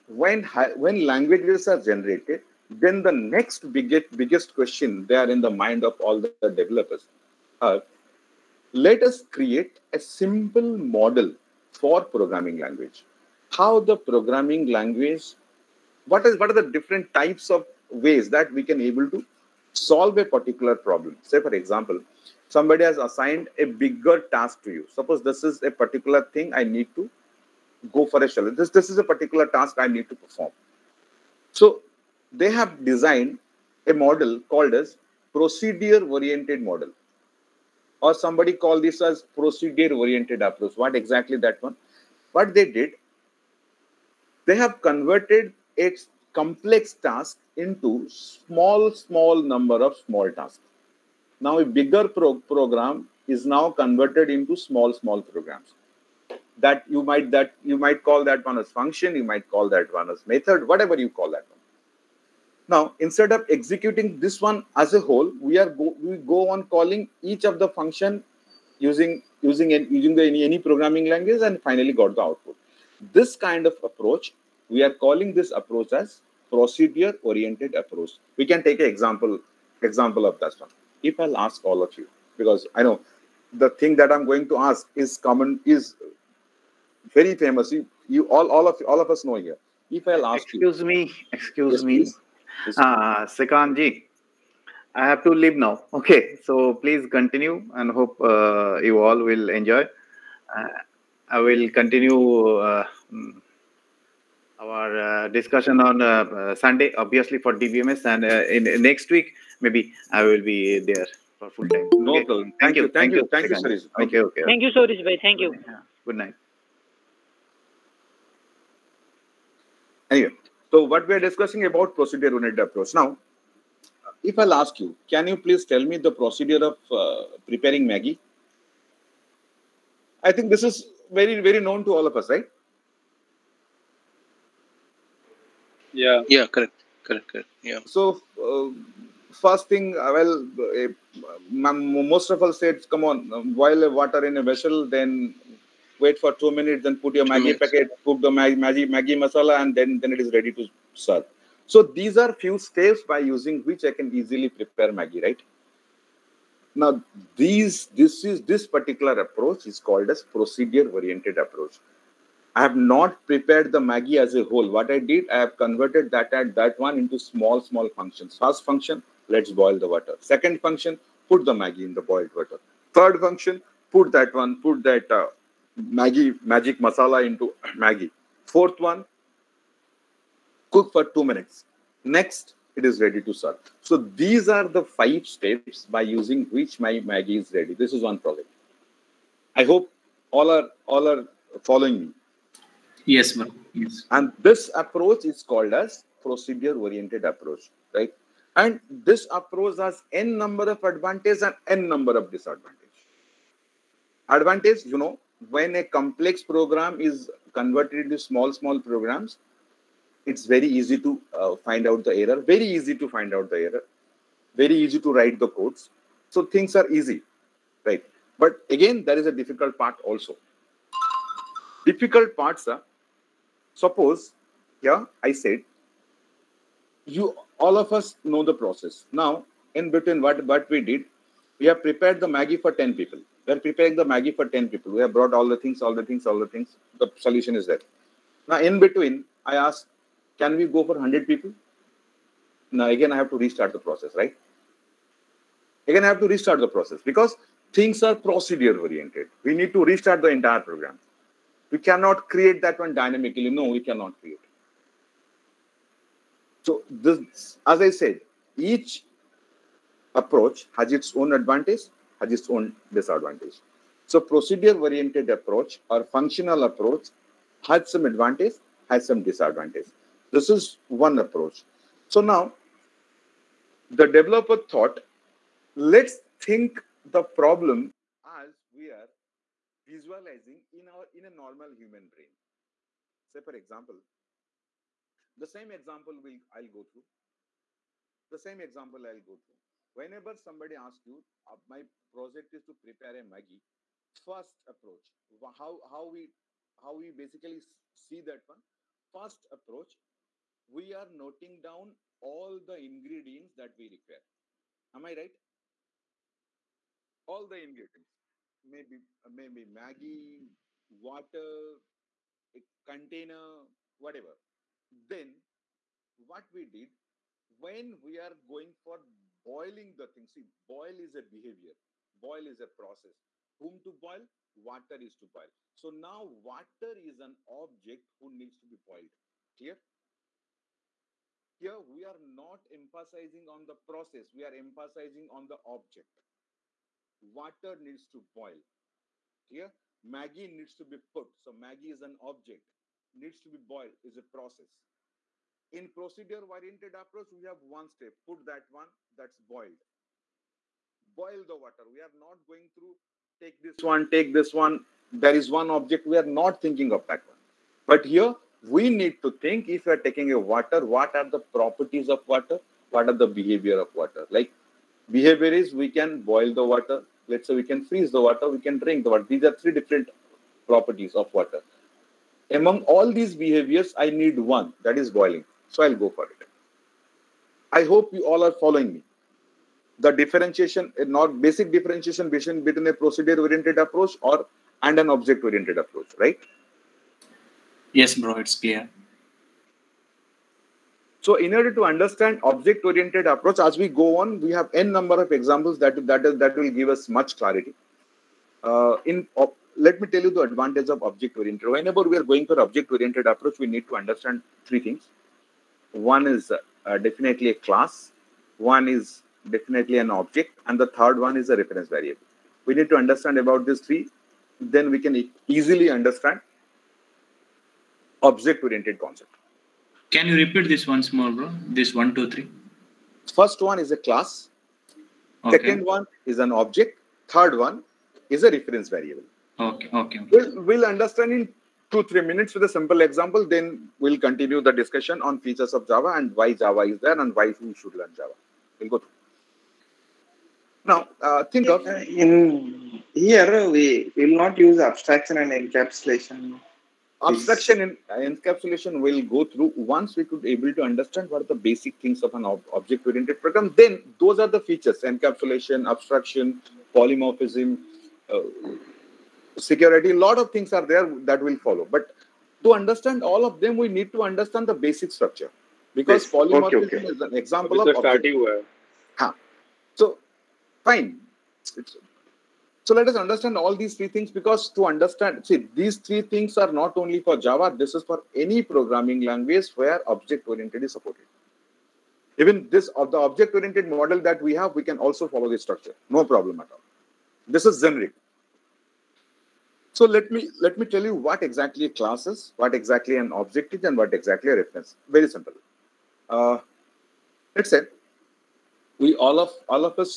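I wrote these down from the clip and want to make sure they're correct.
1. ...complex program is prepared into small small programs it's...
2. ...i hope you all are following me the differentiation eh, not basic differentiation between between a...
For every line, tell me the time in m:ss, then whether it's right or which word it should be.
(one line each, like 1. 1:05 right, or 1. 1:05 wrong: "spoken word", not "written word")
1. 3:25 wrong: "converted", not "prepared"
2. 6:17 right.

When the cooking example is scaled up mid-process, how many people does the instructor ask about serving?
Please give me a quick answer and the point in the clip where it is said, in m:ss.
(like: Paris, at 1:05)
100, at 4:00.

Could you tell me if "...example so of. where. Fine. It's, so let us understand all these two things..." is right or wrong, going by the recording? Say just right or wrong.
wrong.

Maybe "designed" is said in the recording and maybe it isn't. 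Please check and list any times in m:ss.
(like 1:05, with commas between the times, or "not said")
0:32.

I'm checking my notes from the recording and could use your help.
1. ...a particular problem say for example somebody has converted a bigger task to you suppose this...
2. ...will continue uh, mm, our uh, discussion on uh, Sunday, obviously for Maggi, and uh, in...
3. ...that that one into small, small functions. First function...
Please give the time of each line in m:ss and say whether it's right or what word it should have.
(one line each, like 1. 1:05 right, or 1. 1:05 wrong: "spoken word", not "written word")
1. 0:20 wrong: "assigned", not "converted"
2. 1:41 wrong: "DBMS", not "Maggi"
3. 2:46 right.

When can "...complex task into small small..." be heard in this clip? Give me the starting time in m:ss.
0:46.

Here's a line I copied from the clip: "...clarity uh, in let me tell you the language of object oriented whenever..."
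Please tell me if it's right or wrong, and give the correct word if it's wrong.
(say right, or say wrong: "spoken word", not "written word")
wrong: "advantage", not "language".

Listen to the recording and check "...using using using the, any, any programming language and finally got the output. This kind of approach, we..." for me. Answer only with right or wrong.
right.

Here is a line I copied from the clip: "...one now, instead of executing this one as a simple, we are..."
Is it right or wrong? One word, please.
wrong.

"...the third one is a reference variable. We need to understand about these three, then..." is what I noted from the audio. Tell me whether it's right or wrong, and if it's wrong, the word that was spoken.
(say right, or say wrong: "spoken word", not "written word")
right.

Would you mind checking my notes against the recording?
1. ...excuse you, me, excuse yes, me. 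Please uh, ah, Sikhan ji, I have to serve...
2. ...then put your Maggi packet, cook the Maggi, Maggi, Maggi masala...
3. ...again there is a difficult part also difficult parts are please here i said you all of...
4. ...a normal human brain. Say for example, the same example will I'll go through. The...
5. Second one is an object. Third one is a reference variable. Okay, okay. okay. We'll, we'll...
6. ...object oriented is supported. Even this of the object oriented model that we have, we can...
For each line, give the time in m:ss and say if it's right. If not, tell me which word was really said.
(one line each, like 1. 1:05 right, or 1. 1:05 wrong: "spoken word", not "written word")
1. 1:30 wrong: "leave", not "serve"
2. 2:26 right
3. 3:38 wrong: "suppose", not "please"
4. 4:41 right
5. 7:05 right
6. 8:00 right.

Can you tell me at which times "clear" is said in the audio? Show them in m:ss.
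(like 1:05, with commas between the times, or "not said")
5:29, 5:39, 6:28.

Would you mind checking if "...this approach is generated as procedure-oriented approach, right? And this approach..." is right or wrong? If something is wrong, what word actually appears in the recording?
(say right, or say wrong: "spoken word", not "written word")
wrong: "called", not "generated".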